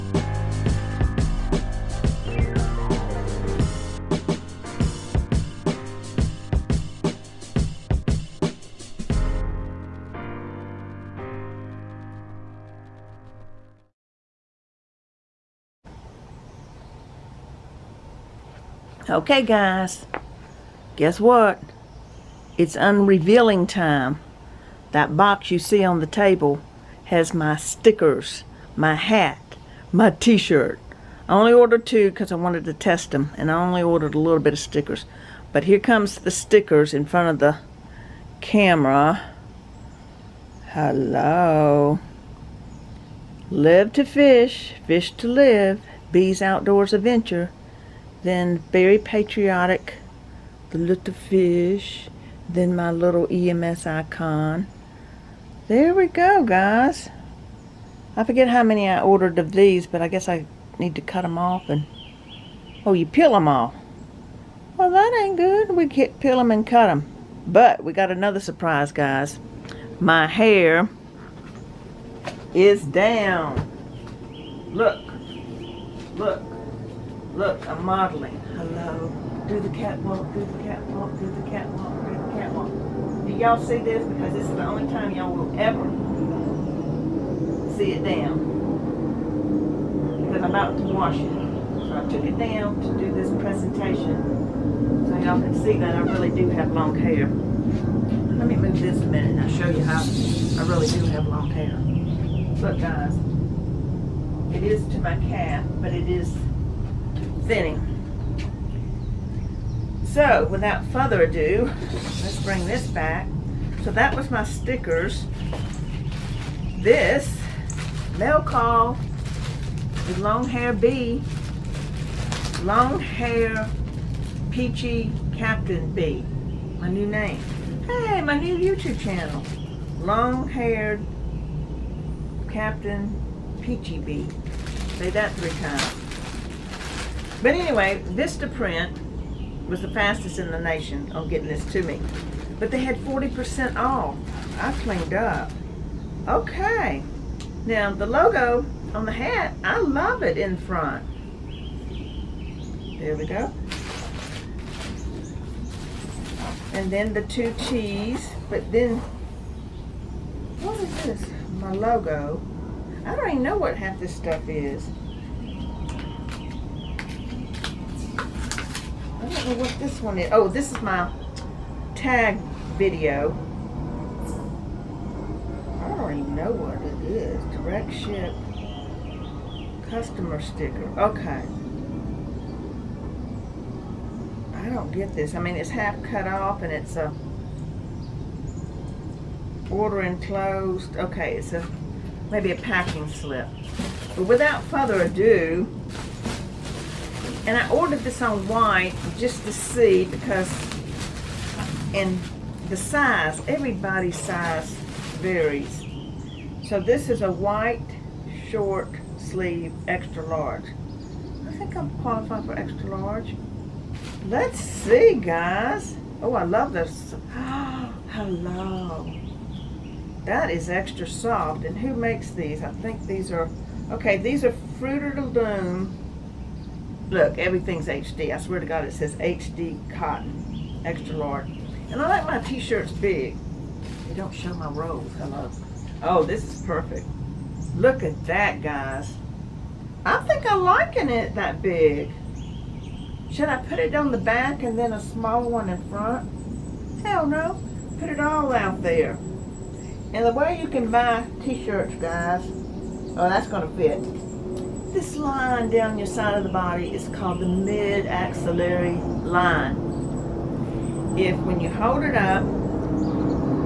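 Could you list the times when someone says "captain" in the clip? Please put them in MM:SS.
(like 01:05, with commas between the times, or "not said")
02:05, 02:12.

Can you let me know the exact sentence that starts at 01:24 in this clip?
Because this is the only time y'all will ever see it down.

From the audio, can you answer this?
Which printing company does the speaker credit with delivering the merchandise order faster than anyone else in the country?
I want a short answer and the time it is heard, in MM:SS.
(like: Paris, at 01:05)
Vistaprint, at 02:18.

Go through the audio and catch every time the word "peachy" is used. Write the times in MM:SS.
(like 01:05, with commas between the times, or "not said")
02:04, 02:13.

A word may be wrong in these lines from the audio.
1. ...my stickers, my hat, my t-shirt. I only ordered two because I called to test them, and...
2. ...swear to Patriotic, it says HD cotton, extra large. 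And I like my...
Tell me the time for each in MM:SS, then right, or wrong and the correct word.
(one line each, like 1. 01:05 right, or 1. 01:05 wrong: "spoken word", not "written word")
1. 00:27 wrong: "wanted", not "called"
2. 03:48 wrong: "God", not "Patriotic".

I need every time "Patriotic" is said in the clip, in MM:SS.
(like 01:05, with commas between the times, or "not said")
00:48.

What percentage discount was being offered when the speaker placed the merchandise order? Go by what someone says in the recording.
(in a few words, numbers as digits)
40%.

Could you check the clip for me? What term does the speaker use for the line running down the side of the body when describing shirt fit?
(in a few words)
mid-axillary line.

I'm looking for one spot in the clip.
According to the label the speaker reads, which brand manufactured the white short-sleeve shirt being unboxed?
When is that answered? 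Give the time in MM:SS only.
03:44.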